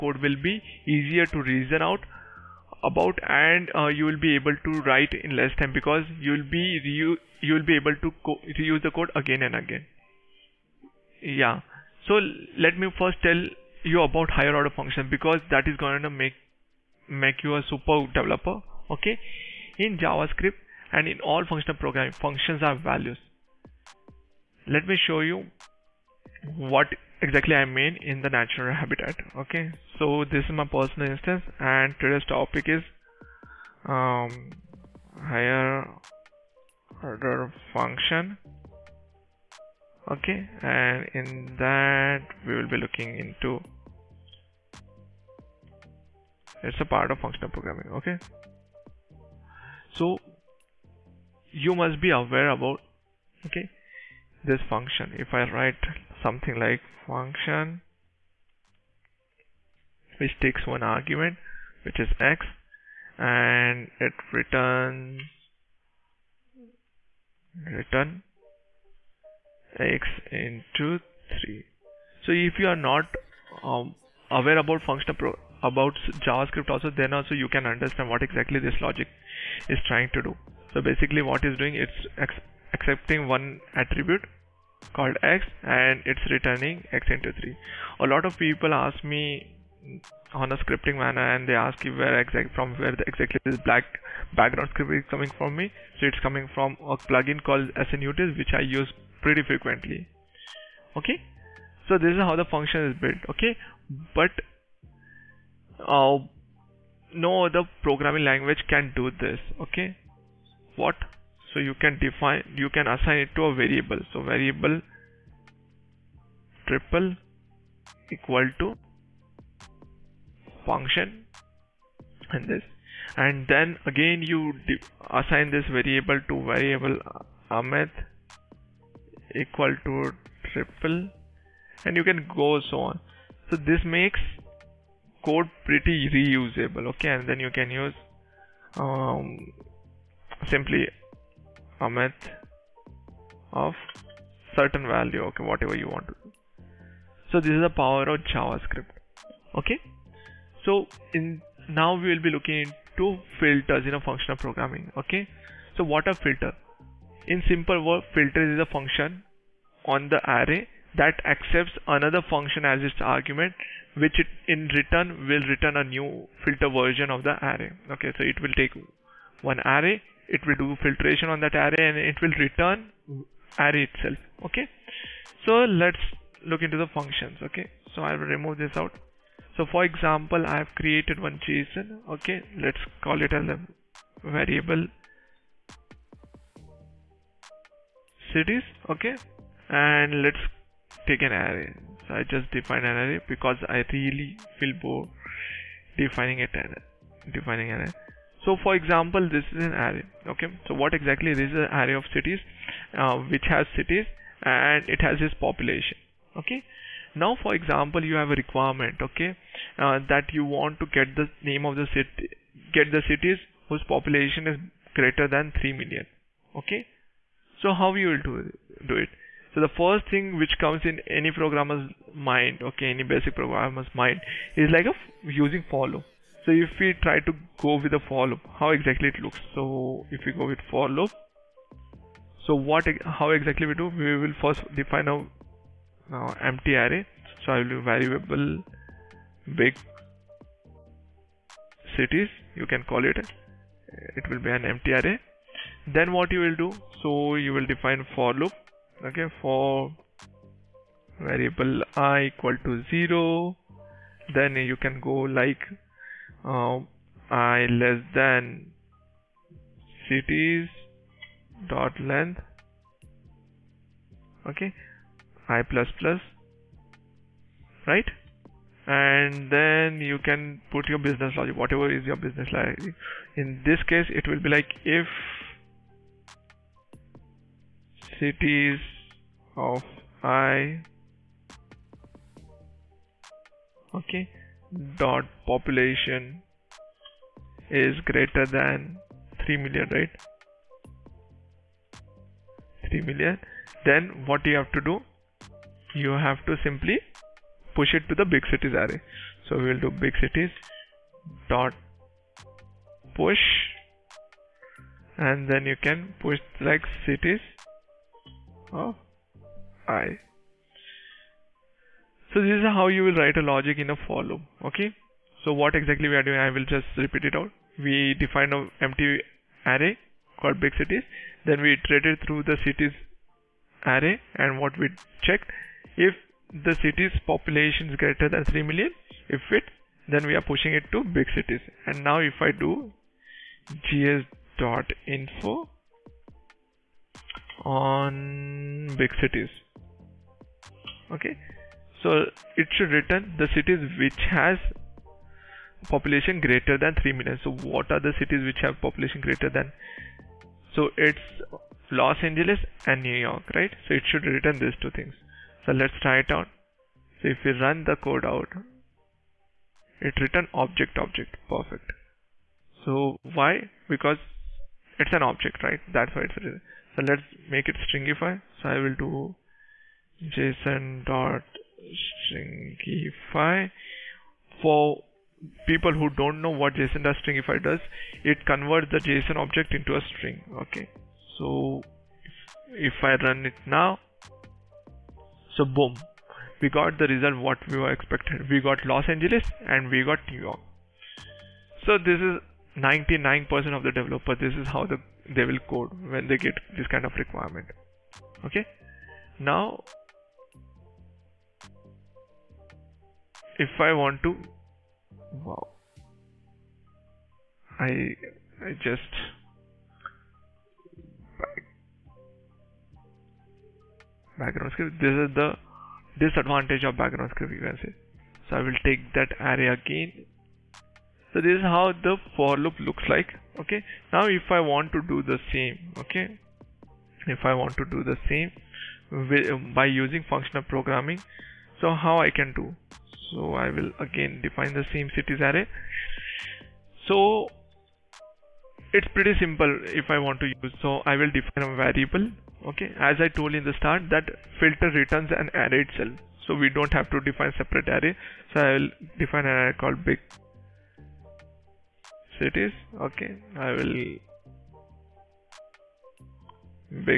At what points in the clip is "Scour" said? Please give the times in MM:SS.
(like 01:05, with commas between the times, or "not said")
not said.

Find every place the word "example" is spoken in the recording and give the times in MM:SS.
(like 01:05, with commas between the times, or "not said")
02:59, 03:18, 03:27.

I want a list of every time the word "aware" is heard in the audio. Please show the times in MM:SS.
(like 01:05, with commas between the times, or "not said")
00:52, 01:14.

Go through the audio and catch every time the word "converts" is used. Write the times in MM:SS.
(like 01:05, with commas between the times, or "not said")
06:18.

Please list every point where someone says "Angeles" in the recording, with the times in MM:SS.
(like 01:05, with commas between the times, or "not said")
05:52, 06:29.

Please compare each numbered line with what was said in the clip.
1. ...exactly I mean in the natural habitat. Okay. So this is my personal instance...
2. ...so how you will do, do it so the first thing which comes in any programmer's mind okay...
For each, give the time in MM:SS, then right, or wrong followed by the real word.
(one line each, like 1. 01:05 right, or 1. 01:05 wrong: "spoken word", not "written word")
1. 00:27 right
2. 03:37 right.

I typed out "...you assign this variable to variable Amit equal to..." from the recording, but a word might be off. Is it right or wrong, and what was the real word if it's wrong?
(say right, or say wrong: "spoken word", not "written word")
right.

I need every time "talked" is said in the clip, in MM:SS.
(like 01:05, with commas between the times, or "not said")
not said.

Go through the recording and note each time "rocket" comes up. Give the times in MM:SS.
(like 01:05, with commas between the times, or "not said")
not said.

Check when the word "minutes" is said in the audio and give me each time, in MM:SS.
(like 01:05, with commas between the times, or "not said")
not said.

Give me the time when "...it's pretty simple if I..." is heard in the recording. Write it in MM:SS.
07:18.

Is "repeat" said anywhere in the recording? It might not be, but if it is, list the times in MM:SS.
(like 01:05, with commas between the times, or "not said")
05:16.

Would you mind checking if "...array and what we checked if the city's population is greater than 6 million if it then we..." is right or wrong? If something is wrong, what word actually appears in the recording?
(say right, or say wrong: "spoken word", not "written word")
wrong: "3", not "6".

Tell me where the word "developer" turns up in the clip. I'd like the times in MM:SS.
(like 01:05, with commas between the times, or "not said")
00:18, 06:33.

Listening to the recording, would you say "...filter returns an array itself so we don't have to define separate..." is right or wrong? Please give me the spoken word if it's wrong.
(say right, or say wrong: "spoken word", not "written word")
right.